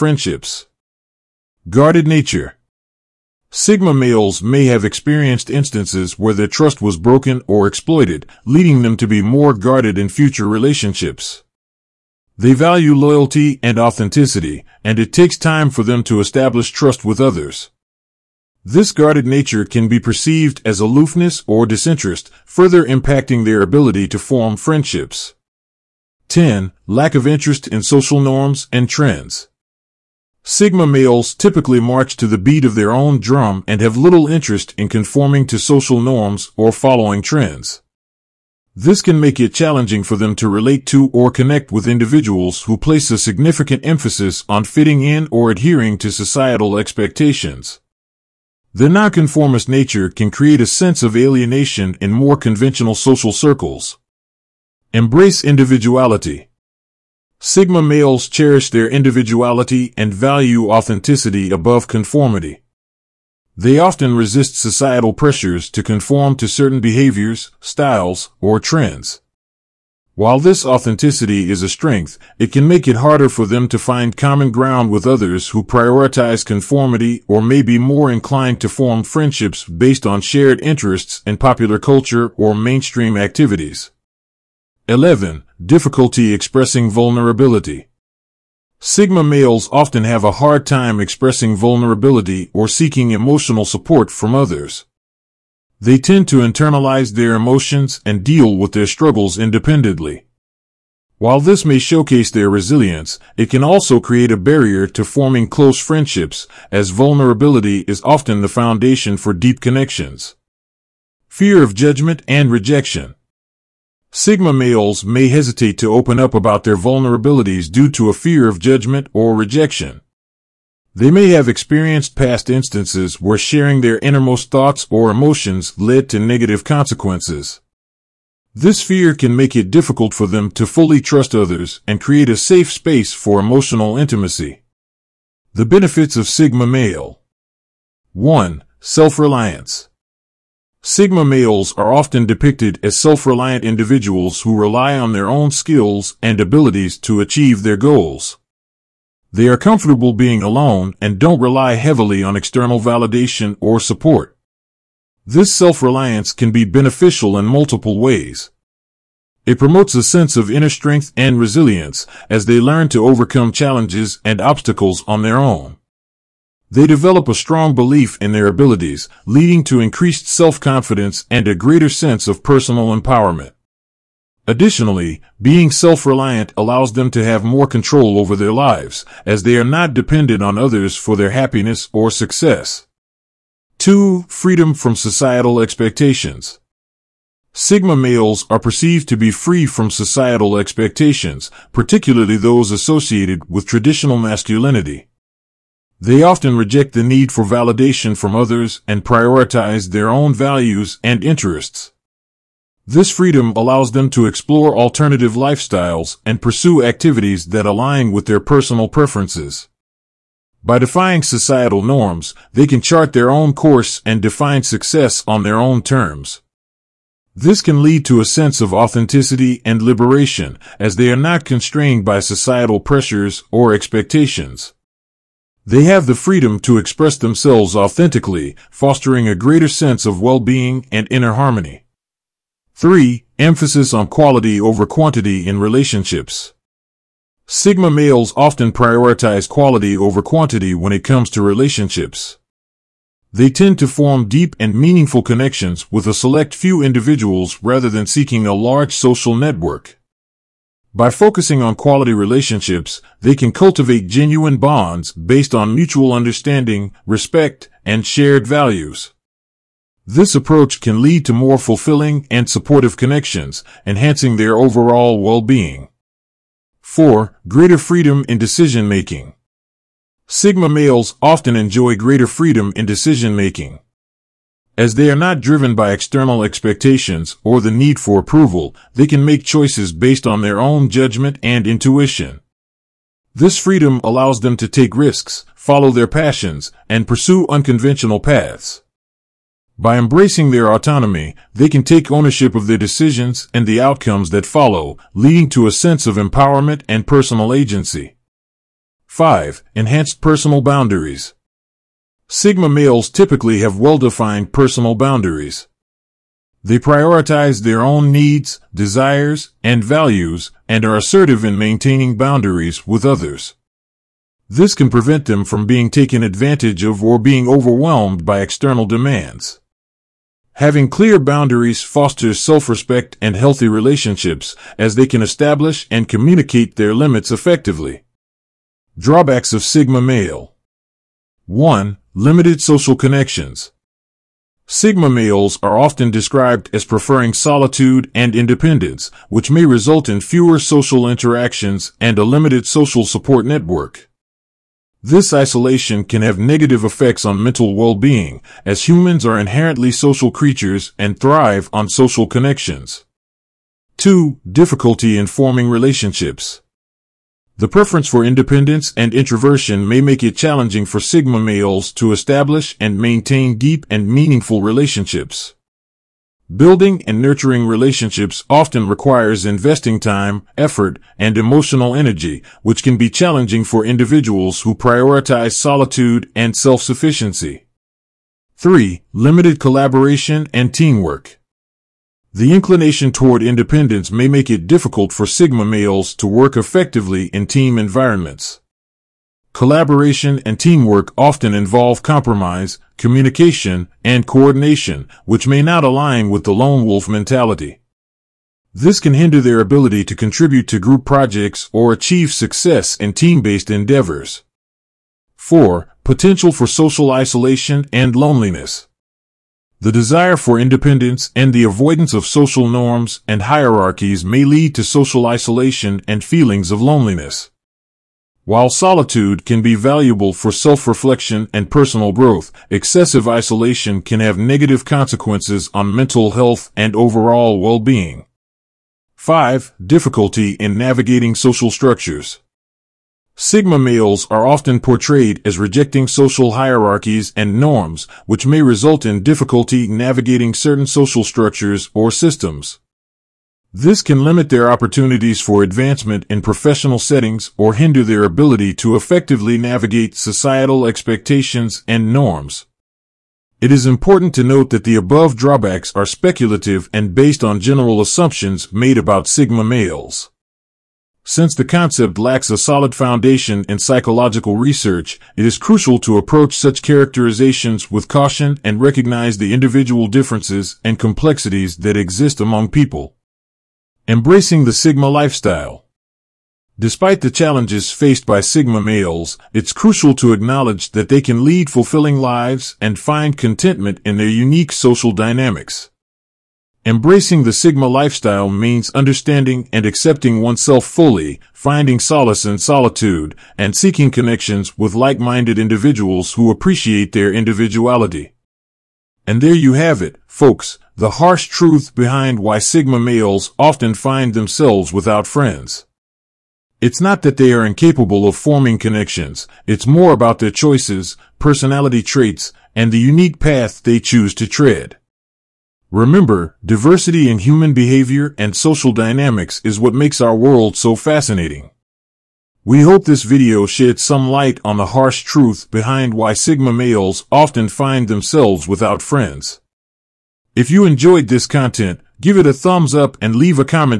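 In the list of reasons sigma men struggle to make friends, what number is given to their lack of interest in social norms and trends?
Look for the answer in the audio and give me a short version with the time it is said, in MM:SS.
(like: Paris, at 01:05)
10, at 00:26.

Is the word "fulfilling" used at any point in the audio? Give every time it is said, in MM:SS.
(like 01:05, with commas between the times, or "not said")
04:21, 08:01.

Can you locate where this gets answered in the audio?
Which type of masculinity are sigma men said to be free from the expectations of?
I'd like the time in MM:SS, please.
03:13.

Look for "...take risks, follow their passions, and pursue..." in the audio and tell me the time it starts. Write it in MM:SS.
04:44.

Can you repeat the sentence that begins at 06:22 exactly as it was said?
The inclination toward independence may make it difficult for Sigma males to work effectively in team environments.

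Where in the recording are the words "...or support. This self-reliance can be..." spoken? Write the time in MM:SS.
02:33.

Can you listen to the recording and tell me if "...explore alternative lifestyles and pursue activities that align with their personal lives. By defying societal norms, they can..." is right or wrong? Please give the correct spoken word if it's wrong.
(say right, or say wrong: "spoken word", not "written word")
wrong: "preferences", not "lives".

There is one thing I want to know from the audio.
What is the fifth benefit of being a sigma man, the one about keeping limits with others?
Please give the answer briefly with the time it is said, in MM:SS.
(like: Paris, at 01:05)
Enhanced personal boundaries, at 04:59.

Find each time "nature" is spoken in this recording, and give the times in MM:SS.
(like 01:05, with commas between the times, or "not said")
00:02, 00:19, 00:49.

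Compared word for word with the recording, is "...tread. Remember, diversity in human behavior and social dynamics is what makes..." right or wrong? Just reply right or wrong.
right.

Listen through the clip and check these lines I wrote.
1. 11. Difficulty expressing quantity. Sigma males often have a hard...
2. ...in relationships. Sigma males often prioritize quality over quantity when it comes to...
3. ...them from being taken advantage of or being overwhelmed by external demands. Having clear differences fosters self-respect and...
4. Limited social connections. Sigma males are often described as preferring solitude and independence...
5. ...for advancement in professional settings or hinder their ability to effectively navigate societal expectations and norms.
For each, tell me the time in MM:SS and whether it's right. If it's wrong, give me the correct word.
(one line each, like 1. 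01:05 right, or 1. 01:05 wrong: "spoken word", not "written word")
1. 01:24 wrong: "vulnerability", not "quantity"
2. 03:55 right
3. 05:15 wrong: "boundaries", not "differences"
4. 05:32 right
5. 07:25 right.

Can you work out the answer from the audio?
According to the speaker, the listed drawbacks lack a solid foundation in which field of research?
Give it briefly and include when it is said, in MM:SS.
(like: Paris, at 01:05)
psychological research, at 07:43.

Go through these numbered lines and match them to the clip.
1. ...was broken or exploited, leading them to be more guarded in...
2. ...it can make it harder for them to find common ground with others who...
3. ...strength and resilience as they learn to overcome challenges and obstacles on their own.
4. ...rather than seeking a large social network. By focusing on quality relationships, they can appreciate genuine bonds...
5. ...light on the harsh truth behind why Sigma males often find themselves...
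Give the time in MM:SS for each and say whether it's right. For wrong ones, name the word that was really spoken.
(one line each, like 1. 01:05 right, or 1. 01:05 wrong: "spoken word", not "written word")
1. 00:06 right
2. 01:12 right
3. 02:40 right
4. 04:07 wrong: "cultivate", not "appreciate"
5. 08:44 right.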